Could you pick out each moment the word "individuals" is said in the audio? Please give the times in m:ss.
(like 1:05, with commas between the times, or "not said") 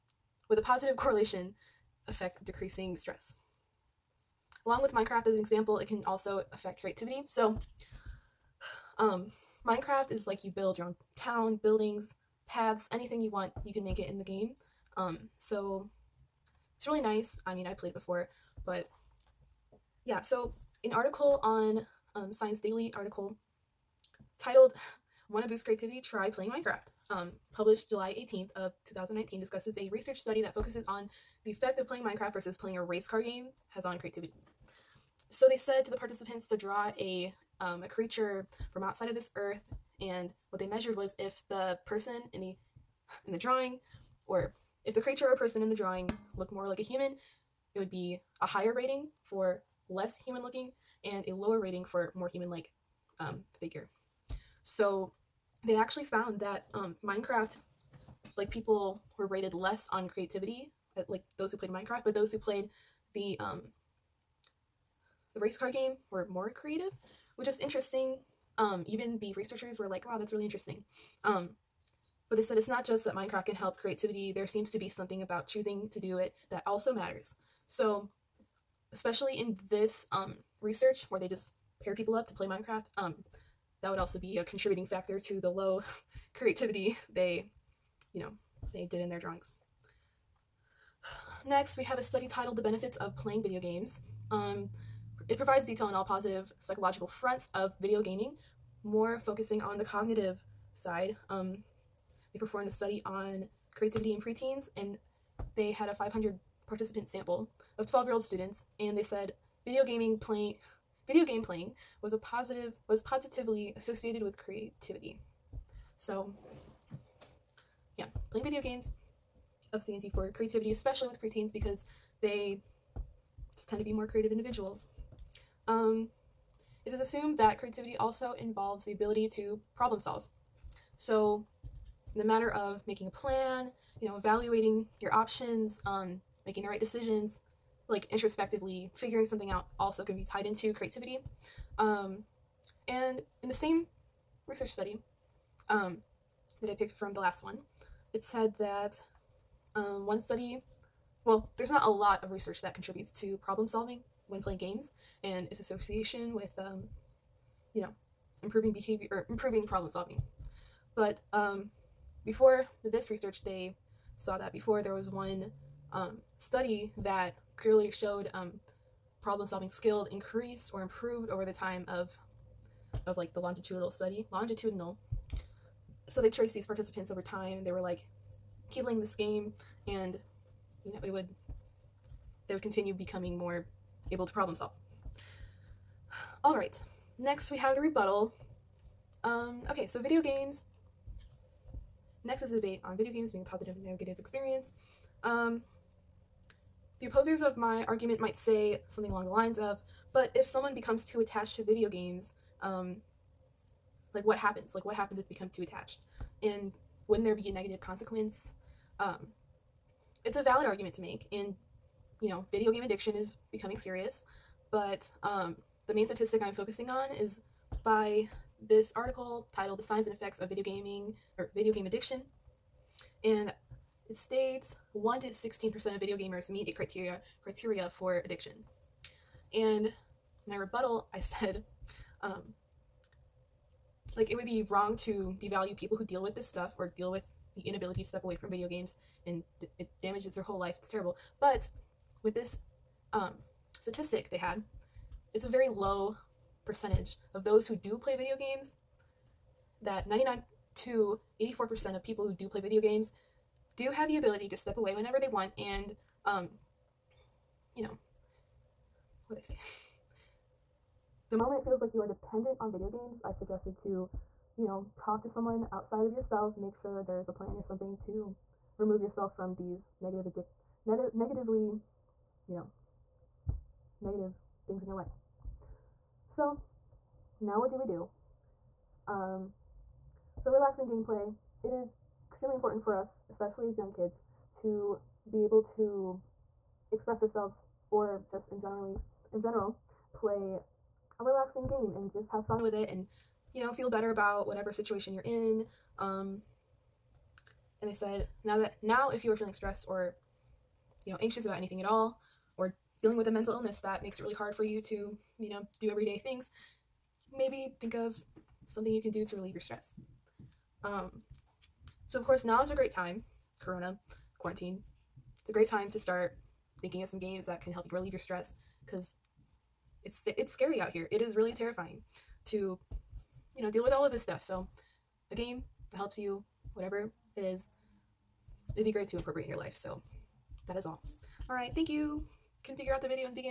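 2:04.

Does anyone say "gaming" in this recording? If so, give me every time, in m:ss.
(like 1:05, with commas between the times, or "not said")
1:38, 1:49, 3:40.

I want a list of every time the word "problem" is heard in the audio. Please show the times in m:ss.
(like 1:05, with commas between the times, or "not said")
2:09, 2:33, 2:39, 2:49, 3:04.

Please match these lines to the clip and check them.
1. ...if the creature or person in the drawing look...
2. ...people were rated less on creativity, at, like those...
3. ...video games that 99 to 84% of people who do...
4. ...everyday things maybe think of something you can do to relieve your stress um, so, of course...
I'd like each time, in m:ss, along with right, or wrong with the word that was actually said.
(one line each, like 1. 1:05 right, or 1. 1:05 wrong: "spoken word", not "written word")
1. 0:44 right
2. 0:58 right
3. 4:08 right
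4. 5:05 right.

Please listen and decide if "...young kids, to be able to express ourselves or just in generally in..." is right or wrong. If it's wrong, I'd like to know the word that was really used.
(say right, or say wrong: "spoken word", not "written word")
right.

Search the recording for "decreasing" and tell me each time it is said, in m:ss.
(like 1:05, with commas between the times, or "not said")
0:02.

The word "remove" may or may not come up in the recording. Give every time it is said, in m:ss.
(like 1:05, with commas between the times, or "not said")
4:28.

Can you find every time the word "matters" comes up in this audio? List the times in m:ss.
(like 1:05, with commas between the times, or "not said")
1:16, 2:12.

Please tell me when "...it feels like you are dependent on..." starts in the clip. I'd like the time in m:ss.
4:21.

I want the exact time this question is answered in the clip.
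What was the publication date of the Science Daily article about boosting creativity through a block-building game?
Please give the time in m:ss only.
0:27.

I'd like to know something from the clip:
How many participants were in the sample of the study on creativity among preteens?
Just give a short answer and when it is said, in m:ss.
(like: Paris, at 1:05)
500, at 1:45.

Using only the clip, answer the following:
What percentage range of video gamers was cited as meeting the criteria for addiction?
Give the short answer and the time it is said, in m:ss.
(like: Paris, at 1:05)
1 to 16%, at 3:44.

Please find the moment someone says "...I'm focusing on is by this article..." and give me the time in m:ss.
3:36.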